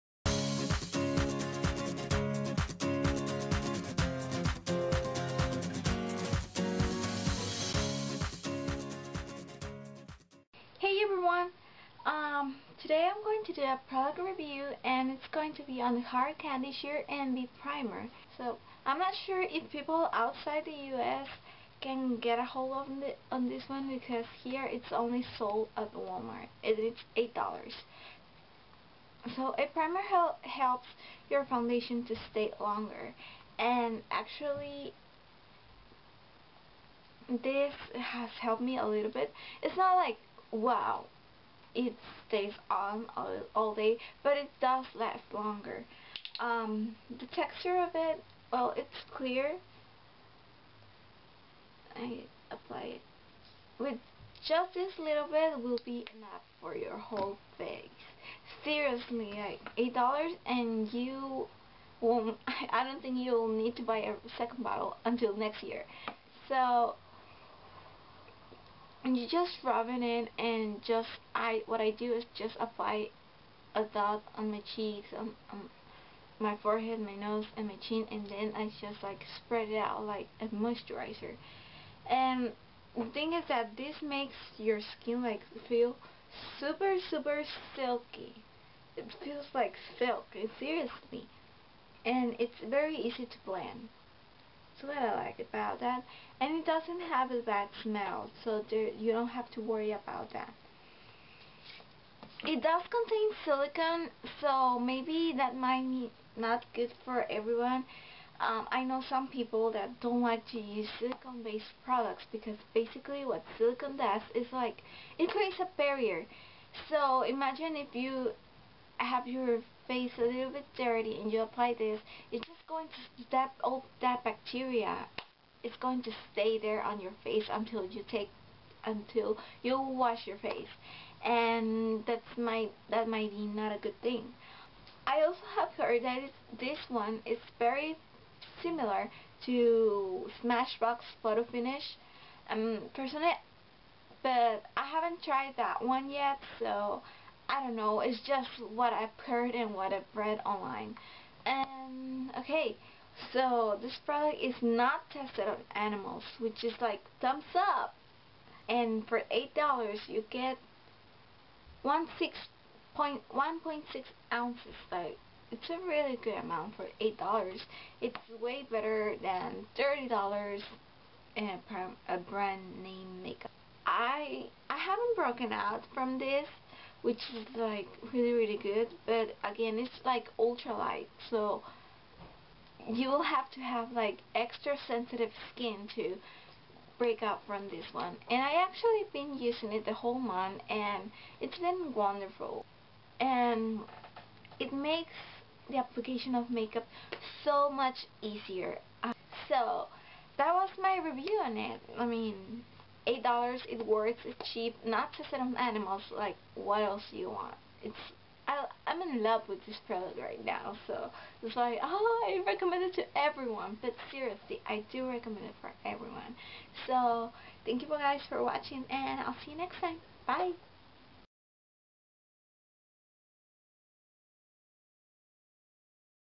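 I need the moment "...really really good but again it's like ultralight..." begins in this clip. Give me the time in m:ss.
2:58.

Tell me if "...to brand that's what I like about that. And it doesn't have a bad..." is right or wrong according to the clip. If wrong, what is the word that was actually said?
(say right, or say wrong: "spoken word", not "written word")
wrong: "blend", not "brand".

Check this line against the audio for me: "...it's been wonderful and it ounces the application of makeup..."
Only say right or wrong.
wrong.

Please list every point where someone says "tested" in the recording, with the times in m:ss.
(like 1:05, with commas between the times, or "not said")
2:35.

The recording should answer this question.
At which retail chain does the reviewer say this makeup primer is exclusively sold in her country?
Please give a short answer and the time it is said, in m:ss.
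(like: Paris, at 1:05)
Walmart, at 0:25.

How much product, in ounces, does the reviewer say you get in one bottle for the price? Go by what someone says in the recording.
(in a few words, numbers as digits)
1.6 ounces.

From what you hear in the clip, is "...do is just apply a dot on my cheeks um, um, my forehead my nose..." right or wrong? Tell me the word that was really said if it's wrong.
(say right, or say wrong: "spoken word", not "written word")
right.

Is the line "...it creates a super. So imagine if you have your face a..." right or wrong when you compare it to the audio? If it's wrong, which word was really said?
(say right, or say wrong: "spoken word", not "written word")
wrong: "barrier", not "super".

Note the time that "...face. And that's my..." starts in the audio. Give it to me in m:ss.
2:10.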